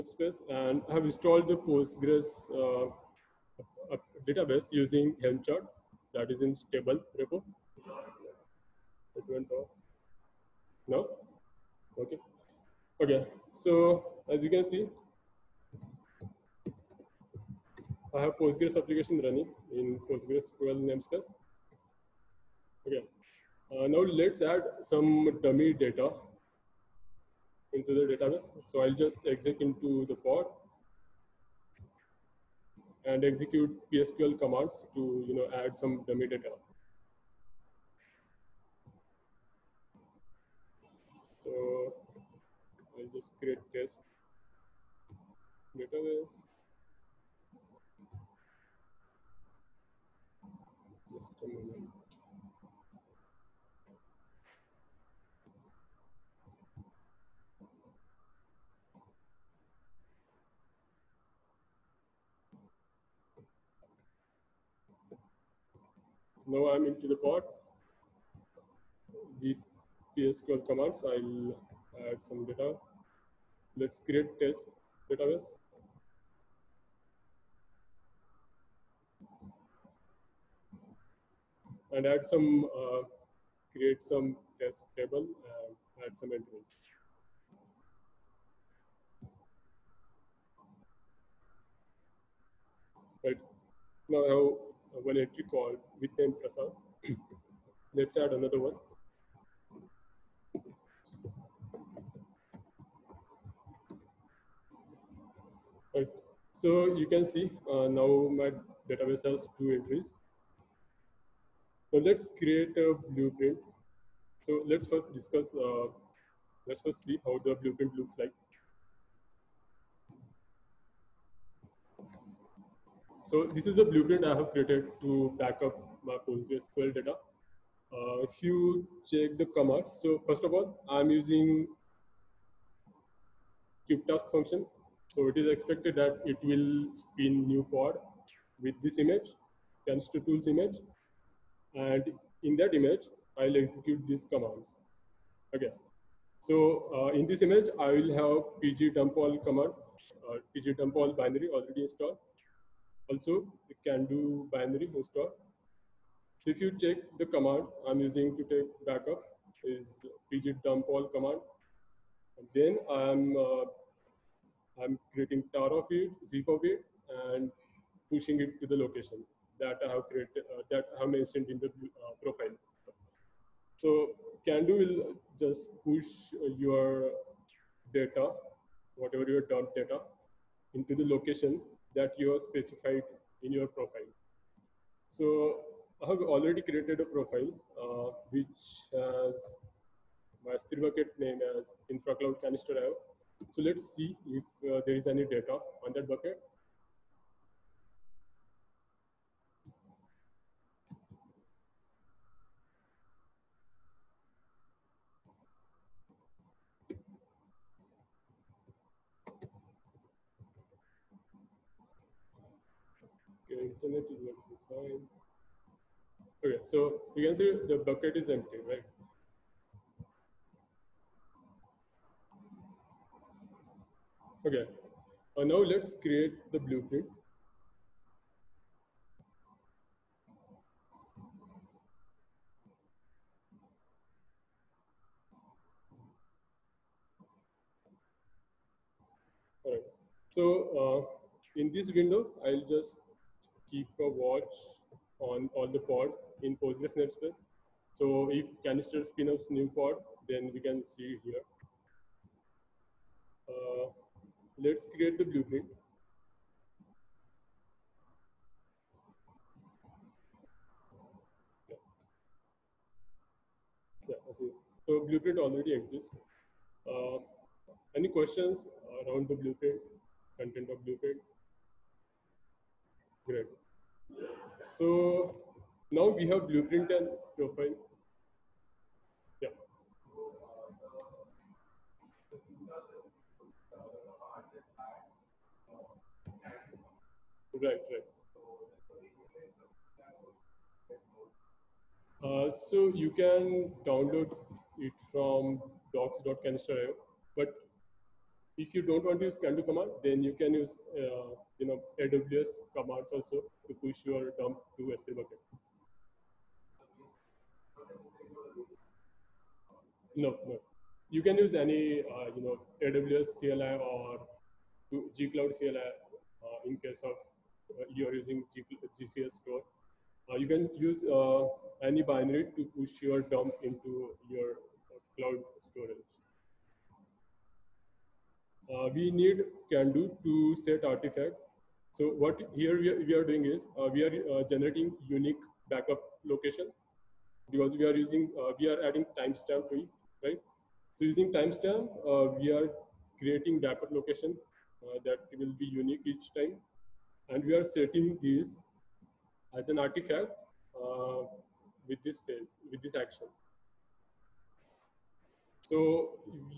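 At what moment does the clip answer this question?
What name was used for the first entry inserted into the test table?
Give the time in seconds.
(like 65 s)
96 s.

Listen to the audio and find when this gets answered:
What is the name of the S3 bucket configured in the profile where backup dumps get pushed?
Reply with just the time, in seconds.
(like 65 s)
191 s.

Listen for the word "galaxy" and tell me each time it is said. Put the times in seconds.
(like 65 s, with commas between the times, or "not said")
not said.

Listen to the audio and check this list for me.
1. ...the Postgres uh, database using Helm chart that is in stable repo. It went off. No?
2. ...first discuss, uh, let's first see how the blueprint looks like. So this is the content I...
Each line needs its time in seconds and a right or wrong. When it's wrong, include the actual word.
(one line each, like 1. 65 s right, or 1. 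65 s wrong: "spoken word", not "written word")
1. 1 s right
2. 114 s wrong: "blueprint", not "content".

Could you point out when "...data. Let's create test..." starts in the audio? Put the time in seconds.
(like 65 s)
72 s.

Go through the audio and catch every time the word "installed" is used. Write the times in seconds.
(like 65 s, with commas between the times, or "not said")
1 s, 151 s.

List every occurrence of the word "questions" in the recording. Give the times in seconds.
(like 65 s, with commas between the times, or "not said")
268 s.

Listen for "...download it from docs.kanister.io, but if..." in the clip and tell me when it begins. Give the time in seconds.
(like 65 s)
293 s.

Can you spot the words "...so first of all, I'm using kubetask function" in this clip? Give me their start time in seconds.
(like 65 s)
130 s.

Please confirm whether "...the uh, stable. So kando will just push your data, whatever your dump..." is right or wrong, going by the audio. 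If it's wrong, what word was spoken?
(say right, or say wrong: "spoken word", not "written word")
wrong: "profile", not "stable".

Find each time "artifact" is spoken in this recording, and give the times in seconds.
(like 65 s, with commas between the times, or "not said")
330 s, 349 s.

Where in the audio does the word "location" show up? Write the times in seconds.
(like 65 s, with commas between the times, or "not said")
168 s, 181 s, 336 s, 343 s.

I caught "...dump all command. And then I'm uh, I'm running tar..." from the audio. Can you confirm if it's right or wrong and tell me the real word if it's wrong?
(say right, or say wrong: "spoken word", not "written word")
wrong: "creating", not "running".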